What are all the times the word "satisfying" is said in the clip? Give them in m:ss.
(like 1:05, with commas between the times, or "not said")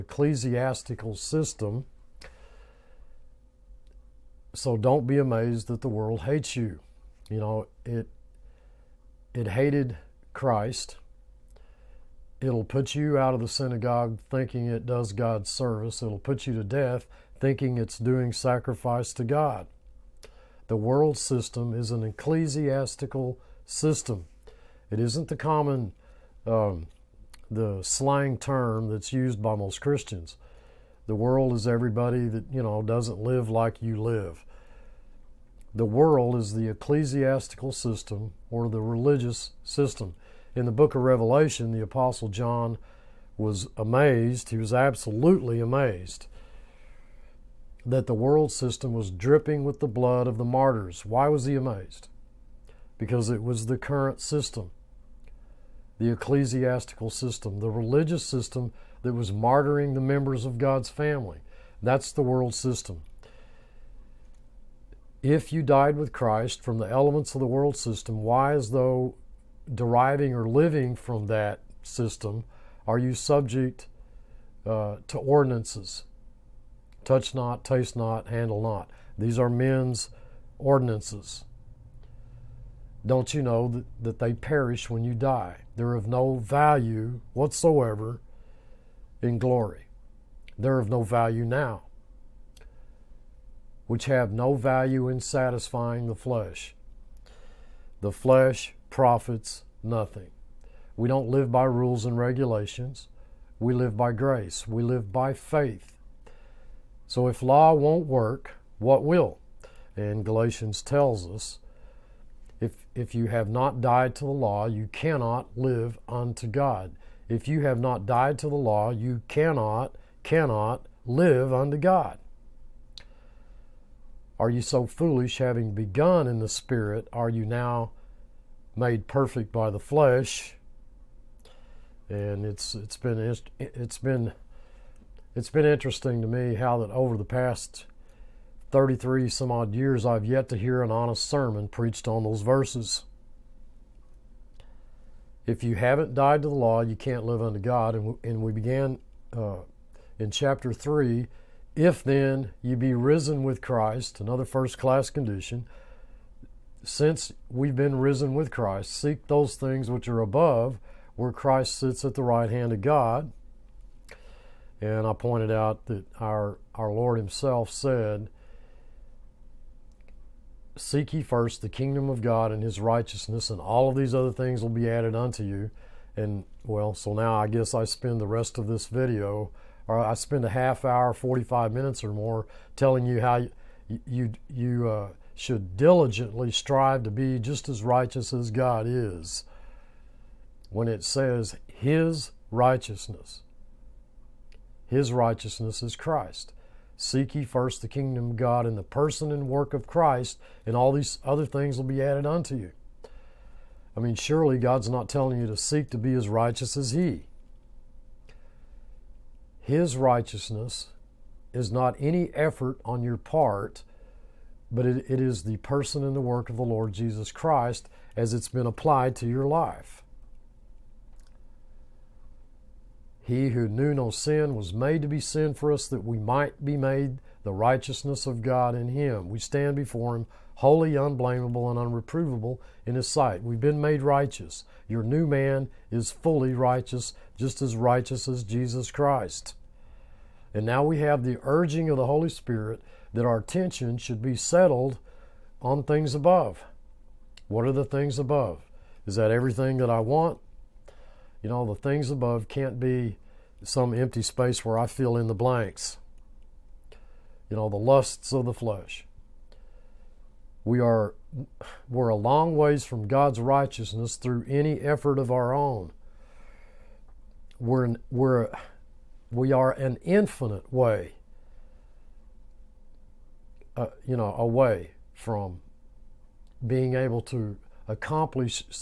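1:35.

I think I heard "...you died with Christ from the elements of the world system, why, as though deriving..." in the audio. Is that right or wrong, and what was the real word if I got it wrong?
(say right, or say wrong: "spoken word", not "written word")
right.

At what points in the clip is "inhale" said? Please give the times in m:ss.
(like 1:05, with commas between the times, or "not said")
not said.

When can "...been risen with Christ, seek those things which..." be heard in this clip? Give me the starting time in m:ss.
2:37.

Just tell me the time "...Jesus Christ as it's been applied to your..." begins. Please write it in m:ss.
3:36.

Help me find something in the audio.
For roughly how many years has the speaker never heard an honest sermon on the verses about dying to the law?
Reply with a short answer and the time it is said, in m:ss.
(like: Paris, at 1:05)
33, at 2:18.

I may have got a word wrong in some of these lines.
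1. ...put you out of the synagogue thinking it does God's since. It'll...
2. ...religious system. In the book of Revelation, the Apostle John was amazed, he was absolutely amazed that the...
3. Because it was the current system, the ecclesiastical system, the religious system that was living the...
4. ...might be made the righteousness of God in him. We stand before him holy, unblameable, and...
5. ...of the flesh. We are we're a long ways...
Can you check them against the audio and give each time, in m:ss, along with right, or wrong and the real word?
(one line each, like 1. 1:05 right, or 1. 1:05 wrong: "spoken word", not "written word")
1. 0:12 wrong: "service", not "since"
2. 0:38 right
3. 0:52 wrong: "martyring", not "living"
4. 3:46 right
5. 4:18 right.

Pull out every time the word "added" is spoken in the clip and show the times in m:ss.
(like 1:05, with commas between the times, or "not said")
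2:54, 3:22.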